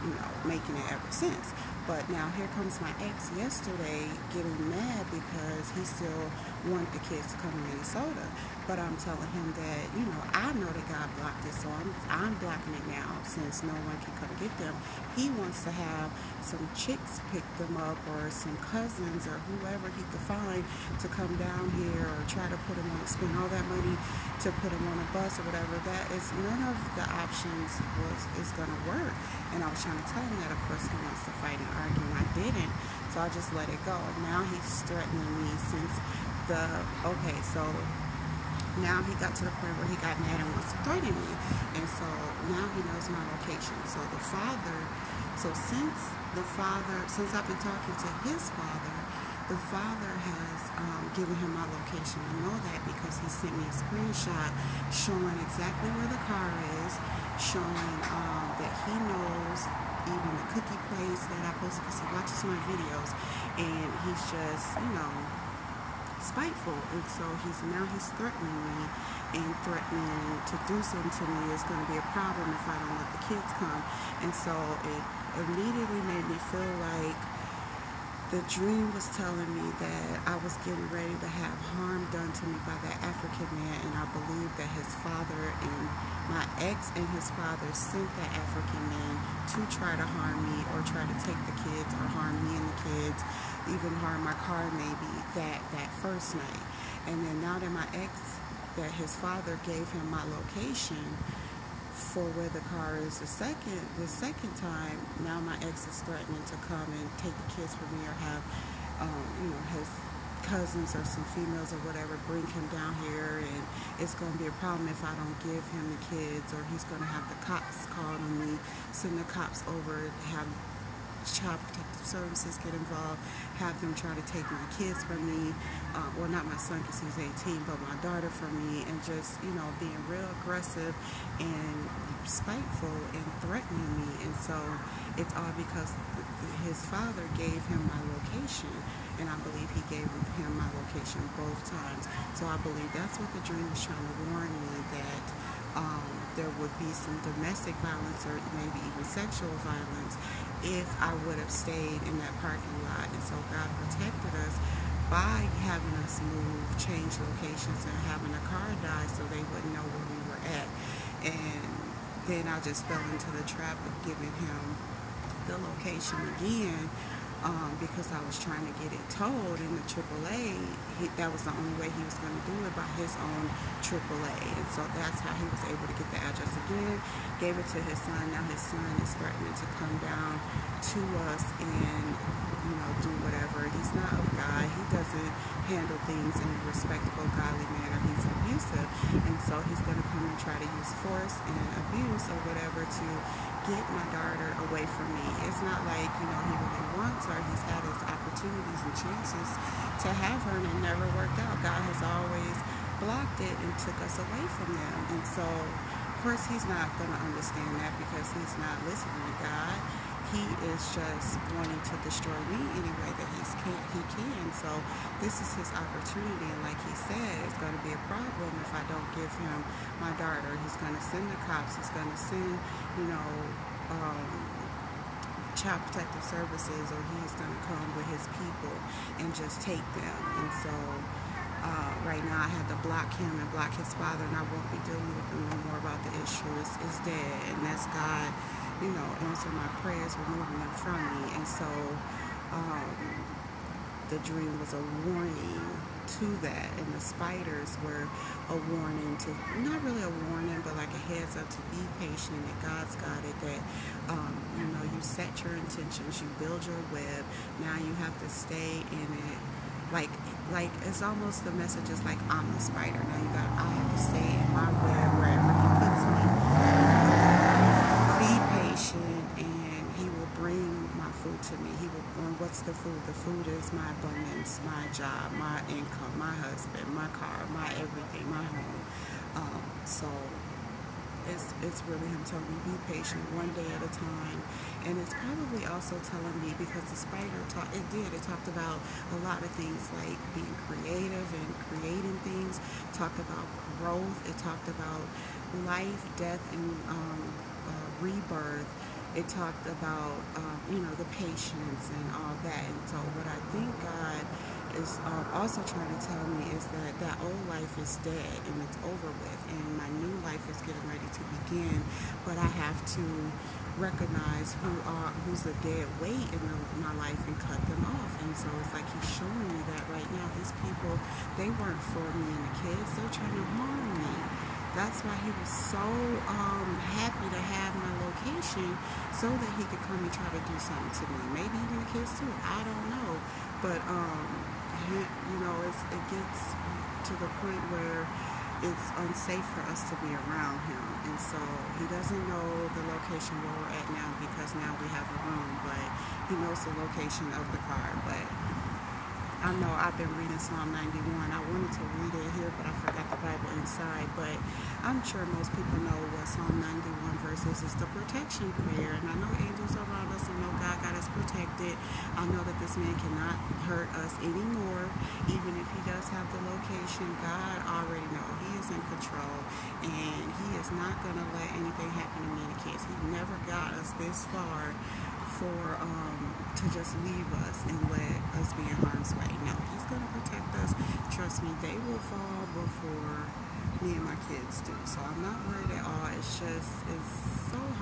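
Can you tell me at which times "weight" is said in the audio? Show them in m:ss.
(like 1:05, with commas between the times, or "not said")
5:16.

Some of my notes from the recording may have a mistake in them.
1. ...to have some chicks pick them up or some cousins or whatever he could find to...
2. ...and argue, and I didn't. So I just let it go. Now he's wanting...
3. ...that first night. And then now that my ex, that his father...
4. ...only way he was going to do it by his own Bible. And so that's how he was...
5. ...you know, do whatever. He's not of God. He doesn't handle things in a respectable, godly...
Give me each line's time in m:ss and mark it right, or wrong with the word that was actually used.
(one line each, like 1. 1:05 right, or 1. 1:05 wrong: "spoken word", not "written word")
1. 0:15 wrong: "whoever", not "whatever"
2. 0:31 wrong: "threatening", not "wanting"
3. 1:35 right
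4. 2:51 wrong: "AAA", not "Bible"
5. 3:02 right.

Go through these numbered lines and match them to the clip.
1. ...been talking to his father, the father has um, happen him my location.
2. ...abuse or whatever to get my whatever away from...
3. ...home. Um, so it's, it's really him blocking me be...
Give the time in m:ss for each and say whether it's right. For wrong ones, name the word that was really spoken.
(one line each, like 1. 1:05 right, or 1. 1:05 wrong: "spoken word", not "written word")
1. 0:47 wrong: "given", not "happen"
2. 3:11 wrong: "daughter", not "whatever"
3. 4:38 wrong: "telling", not "blocking".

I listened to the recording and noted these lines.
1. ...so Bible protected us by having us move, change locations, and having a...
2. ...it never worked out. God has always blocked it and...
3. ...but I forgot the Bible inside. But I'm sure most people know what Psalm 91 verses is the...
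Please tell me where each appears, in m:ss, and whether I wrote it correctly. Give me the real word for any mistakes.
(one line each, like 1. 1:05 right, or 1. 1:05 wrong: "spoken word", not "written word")
1. 2:33 wrong: "God", not "Bible"
2. 3:20 right
3. 5:52 right.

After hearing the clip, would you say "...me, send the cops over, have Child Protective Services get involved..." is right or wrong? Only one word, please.
right.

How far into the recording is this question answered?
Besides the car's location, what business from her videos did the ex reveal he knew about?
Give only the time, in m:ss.
1:00.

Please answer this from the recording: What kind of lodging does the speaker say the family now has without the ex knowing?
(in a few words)
a room.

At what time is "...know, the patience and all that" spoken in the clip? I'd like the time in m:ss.
5:00.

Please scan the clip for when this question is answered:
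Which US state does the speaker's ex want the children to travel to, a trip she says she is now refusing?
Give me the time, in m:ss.
0:07.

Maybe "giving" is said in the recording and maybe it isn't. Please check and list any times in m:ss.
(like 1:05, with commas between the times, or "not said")
2:44.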